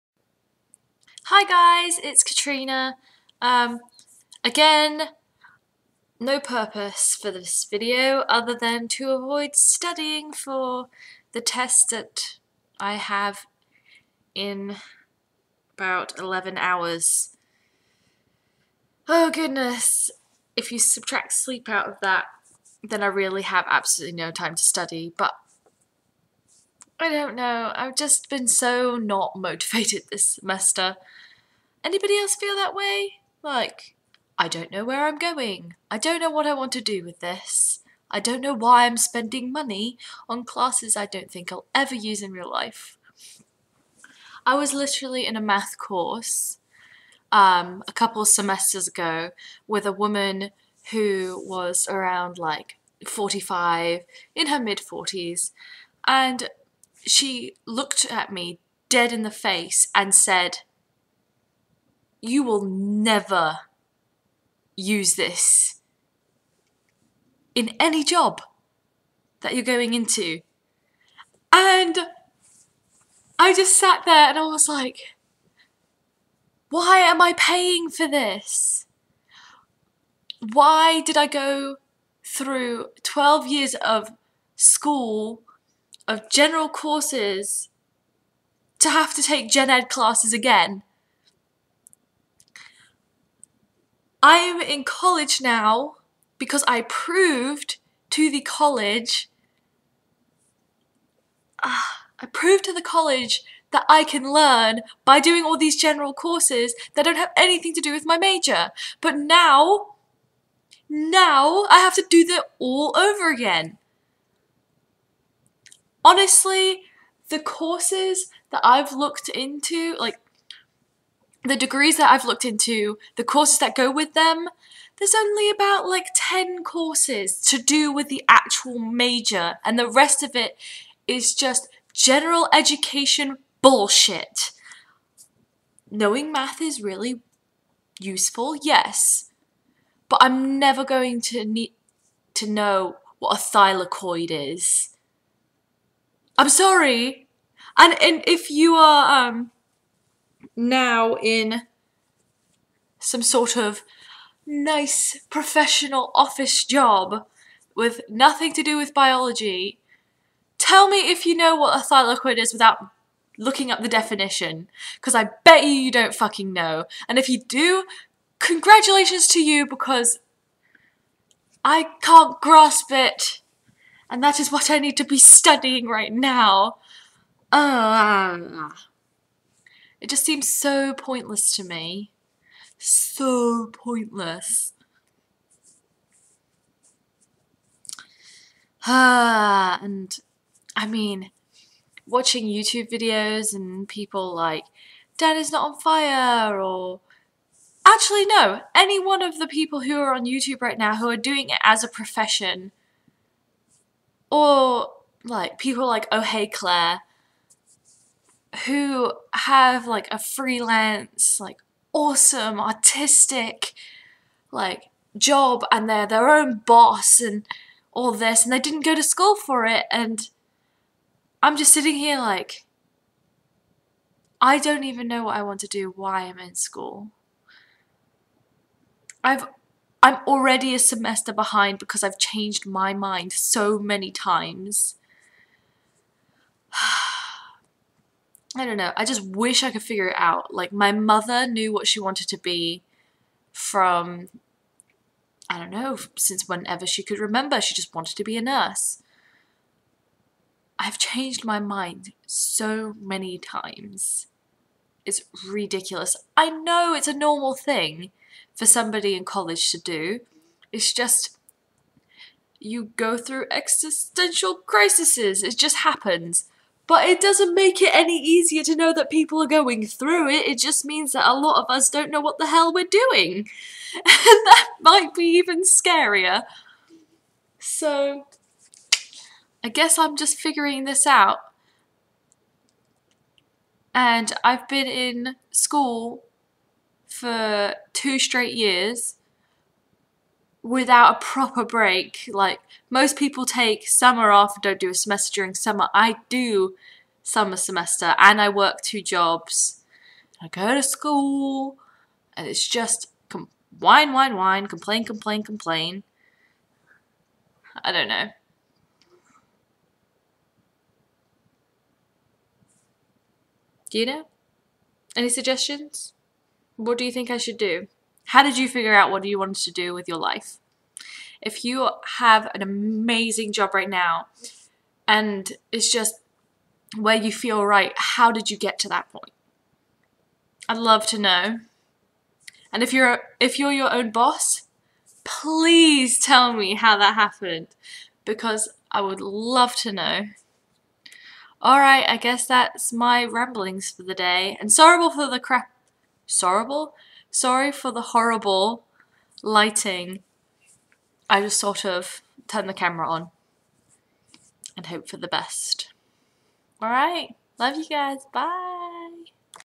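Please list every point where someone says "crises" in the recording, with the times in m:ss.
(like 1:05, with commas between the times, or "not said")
4:24.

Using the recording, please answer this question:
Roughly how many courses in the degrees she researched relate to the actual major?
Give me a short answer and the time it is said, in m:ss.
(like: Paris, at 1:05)
10, at 2:06.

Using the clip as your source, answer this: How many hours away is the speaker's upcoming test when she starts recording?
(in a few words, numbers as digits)
11.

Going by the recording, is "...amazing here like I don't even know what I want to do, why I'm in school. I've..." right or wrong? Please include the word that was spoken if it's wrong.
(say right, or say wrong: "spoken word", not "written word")
wrong: "sitting", not "amazing".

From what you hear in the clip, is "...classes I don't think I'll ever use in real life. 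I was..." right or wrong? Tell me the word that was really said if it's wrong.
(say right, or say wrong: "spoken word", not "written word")
right.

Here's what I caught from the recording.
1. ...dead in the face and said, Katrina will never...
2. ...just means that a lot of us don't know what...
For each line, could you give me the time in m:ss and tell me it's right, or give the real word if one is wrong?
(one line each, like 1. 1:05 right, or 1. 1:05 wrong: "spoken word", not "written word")
1. 0:58 wrong: "You", not "Katrina"
2. 4:30 right.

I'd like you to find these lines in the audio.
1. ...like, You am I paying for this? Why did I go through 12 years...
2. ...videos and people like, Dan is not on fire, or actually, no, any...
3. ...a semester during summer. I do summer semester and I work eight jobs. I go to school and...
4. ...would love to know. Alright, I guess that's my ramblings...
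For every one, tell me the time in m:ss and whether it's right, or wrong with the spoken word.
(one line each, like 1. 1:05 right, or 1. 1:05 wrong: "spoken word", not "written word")
1. 1:14 wrong: "Why", not "You"
2. 3:12 right
3. 4:54 wrong: "two", not "eight"
4. 5:39 right.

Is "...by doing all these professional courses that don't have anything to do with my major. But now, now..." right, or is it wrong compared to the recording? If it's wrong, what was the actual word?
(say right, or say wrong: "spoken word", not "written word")
wrong: "general", not "professional".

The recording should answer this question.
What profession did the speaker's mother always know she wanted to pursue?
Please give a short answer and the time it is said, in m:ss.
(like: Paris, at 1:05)
nurse, at 4:08.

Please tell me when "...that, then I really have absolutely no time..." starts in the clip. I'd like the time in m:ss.
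0:22.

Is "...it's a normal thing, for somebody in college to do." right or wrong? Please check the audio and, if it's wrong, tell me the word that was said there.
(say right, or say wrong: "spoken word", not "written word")
right.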